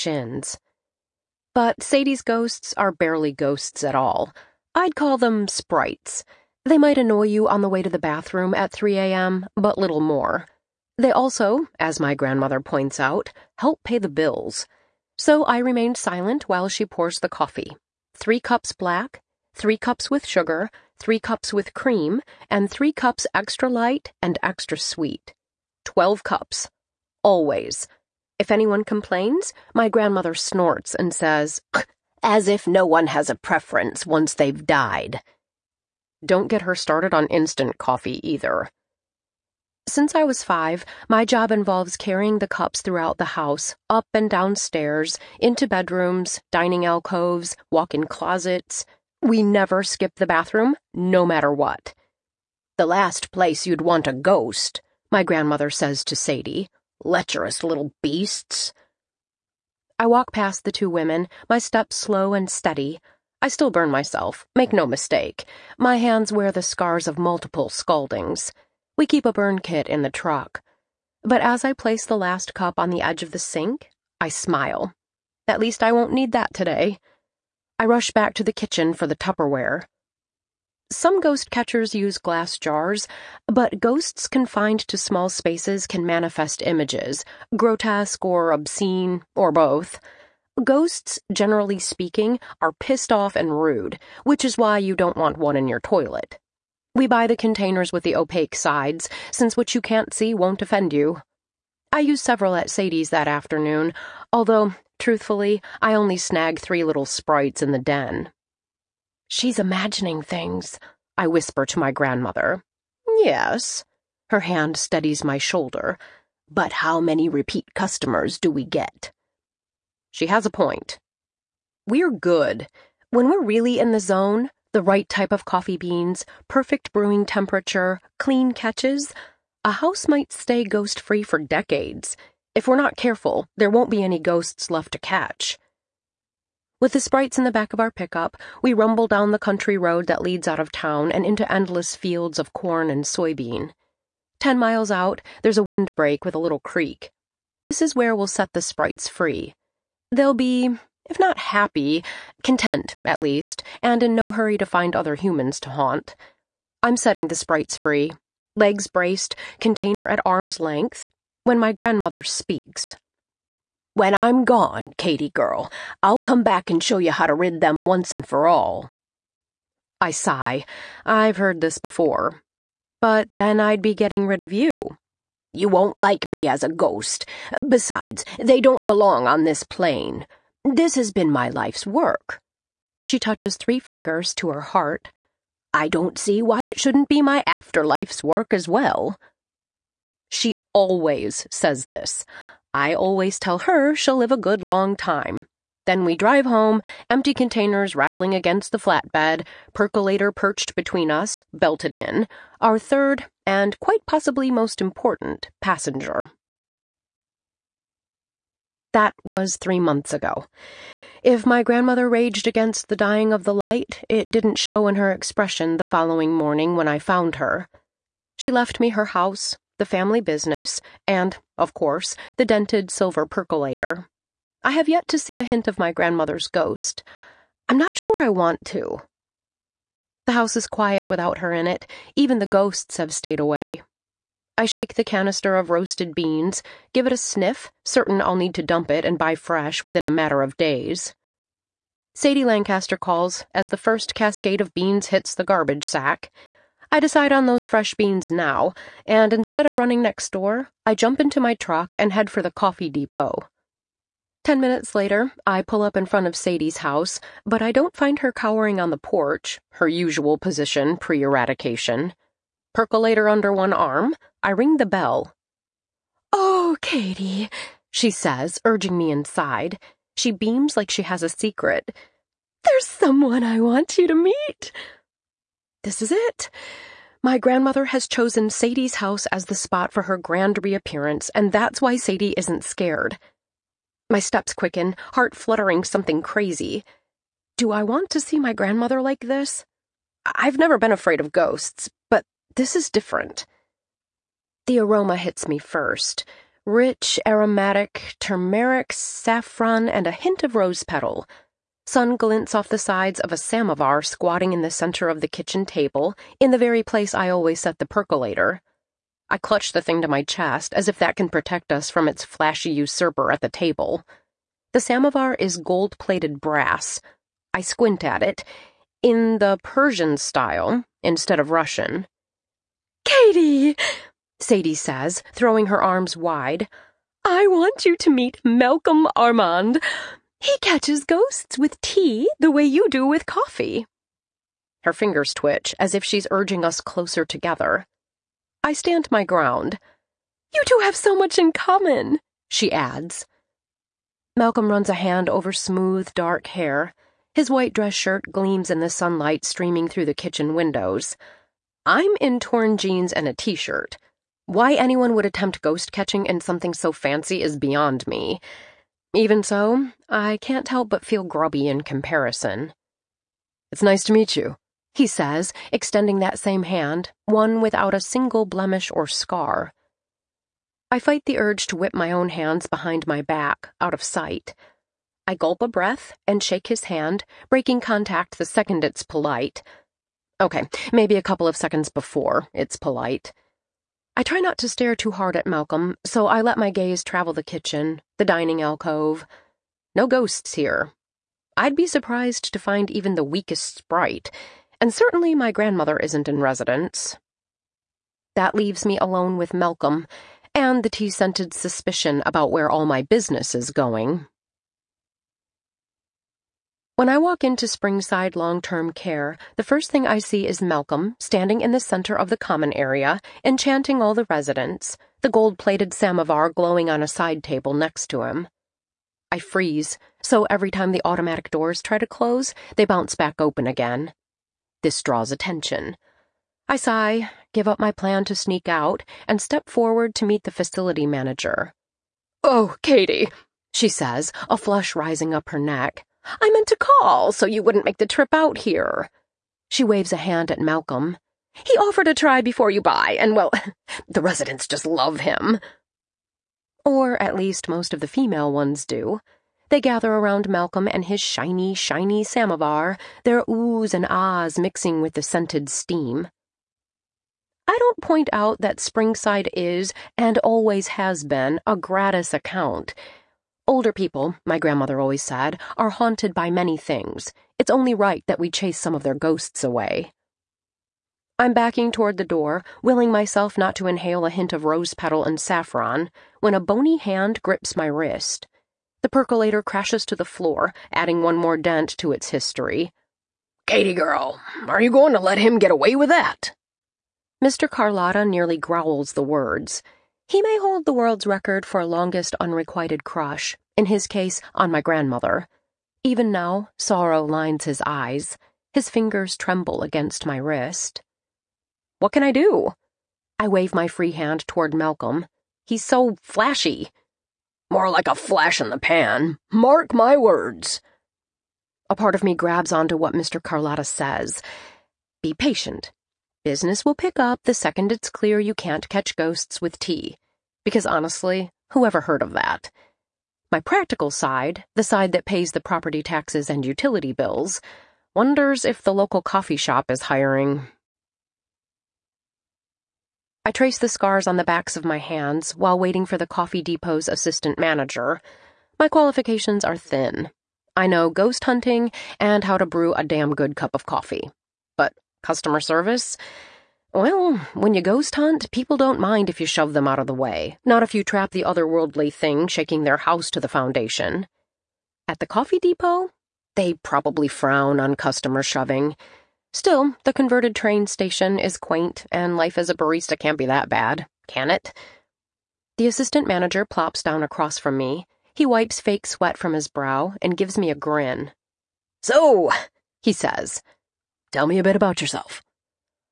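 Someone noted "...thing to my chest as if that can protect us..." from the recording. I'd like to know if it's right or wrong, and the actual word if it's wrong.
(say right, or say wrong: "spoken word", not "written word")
right.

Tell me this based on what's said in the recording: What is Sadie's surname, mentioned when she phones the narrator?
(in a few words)
Lancaster.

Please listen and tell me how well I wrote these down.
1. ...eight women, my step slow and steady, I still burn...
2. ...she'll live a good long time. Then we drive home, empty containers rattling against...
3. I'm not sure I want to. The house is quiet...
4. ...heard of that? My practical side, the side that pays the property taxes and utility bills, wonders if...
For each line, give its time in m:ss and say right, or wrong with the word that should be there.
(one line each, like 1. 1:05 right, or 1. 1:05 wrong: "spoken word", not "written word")
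1. 1:00 wrong: "two", not "eight"
2. 3:13 right
3. 3:47 right
4. 8:42 right.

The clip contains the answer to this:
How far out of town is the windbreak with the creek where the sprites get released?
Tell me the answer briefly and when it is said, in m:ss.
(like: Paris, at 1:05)
10 miles, at 2:24.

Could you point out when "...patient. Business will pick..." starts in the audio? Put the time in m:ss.
8:35.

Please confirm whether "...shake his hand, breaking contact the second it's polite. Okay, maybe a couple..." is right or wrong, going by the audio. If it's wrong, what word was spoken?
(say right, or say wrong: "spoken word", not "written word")
right.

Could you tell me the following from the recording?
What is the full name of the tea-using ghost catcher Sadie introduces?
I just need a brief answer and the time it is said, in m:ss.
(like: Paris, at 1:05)
Malcolm Armand, at 5:28.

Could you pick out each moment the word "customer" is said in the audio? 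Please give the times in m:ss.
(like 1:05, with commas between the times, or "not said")
1:57, 9:05, 9:17.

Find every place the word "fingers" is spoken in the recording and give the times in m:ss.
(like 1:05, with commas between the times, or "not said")
3:03, 5:34, 8:18.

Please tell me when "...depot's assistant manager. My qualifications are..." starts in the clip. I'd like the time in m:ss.
8:56.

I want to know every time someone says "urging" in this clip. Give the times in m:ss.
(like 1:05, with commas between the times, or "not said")
4:28, 5:36.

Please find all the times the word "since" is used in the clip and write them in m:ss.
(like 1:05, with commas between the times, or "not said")
0:39, 1:39.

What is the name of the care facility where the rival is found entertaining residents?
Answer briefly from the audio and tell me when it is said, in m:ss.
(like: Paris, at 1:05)
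Springside Long Term Care, at 6:47.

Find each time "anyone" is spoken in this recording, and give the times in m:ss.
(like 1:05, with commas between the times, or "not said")
0:28, 5:54.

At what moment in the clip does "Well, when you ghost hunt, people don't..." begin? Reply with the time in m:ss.
9:06.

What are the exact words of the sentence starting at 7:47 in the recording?
It's only right that we chase some of their ghosts away.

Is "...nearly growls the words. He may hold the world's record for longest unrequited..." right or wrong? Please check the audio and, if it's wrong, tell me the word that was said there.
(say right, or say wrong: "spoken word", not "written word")
right.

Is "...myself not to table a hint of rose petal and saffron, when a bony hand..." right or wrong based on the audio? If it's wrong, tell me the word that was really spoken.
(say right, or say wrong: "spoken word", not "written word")
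wrong: "inhale", not "table".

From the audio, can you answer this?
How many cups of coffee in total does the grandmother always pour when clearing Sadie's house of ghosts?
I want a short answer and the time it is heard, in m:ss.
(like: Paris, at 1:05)
12, at 0:25.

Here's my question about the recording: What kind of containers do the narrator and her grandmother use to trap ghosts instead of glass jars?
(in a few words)
Tupperware.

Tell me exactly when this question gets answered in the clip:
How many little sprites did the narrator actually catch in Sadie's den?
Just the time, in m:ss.
1:46.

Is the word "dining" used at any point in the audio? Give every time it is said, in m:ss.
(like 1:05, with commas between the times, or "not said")
0:46, 6:28.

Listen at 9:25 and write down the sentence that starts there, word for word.
The assistant manager plops down across from me.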